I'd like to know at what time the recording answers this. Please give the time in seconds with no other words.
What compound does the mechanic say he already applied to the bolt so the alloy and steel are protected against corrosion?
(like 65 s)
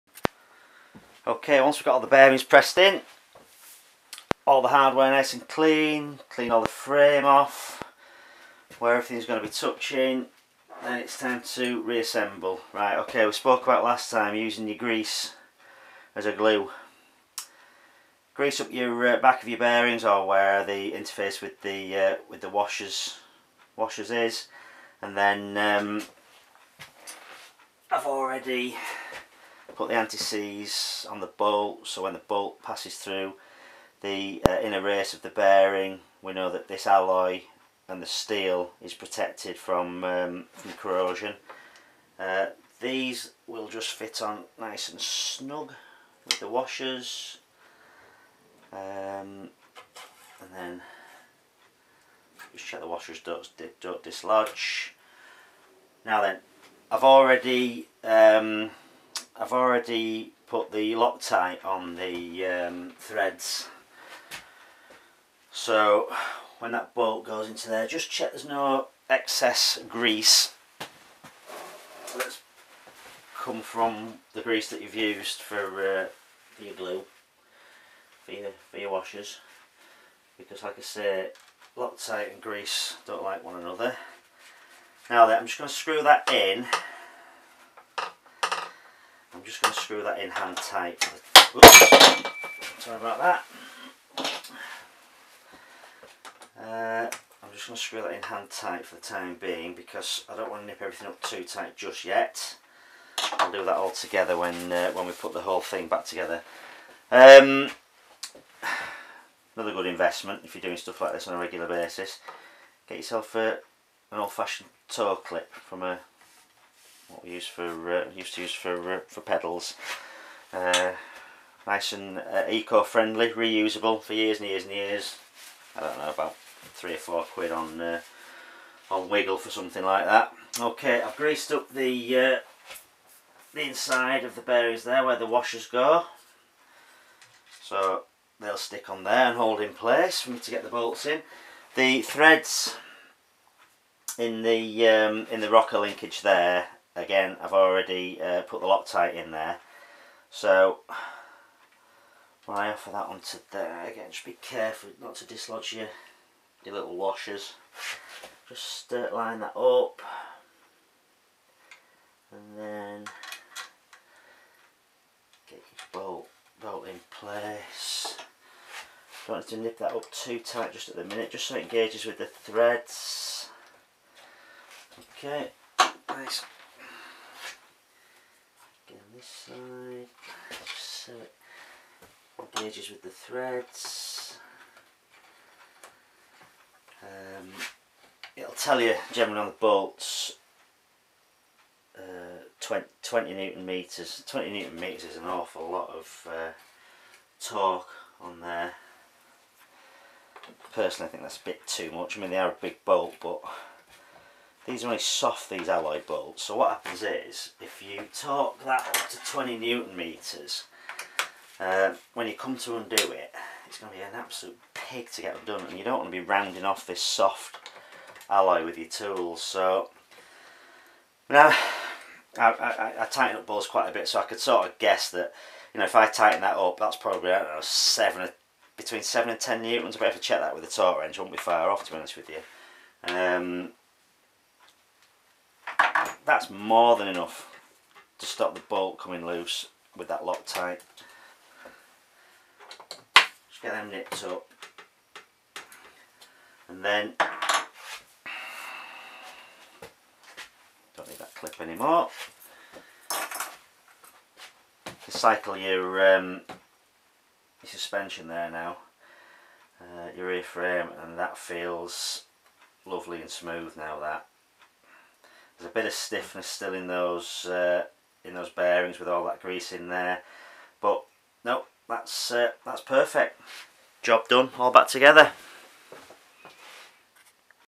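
29 s.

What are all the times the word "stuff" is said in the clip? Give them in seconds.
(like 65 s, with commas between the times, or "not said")
110 s.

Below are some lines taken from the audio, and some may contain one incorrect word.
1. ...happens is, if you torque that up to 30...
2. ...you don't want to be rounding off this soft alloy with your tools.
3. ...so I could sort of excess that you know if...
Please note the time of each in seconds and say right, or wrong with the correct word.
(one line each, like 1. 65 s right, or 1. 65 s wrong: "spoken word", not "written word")
1. 206 s wrong: "20", not "30"
2. 215 s right
3. 224 s wrong: "guess", not "excess".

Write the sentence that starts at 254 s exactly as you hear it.
You cycle your, um, your suspension there now, uh, your rear frame, and that feels lovely and smooth now that.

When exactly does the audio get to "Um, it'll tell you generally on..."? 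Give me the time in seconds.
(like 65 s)
187 s.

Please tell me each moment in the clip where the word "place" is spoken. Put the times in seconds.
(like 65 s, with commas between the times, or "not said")
139 s, 167 s.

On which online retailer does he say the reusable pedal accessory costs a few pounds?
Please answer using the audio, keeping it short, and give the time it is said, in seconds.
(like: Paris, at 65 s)
Wiggle, at 129 s.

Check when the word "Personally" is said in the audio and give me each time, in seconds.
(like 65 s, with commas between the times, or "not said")
200 s.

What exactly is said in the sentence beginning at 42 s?
Uh, these will just fit on nice and snug with the washers um, and then just check the washers don't, don't dislodge.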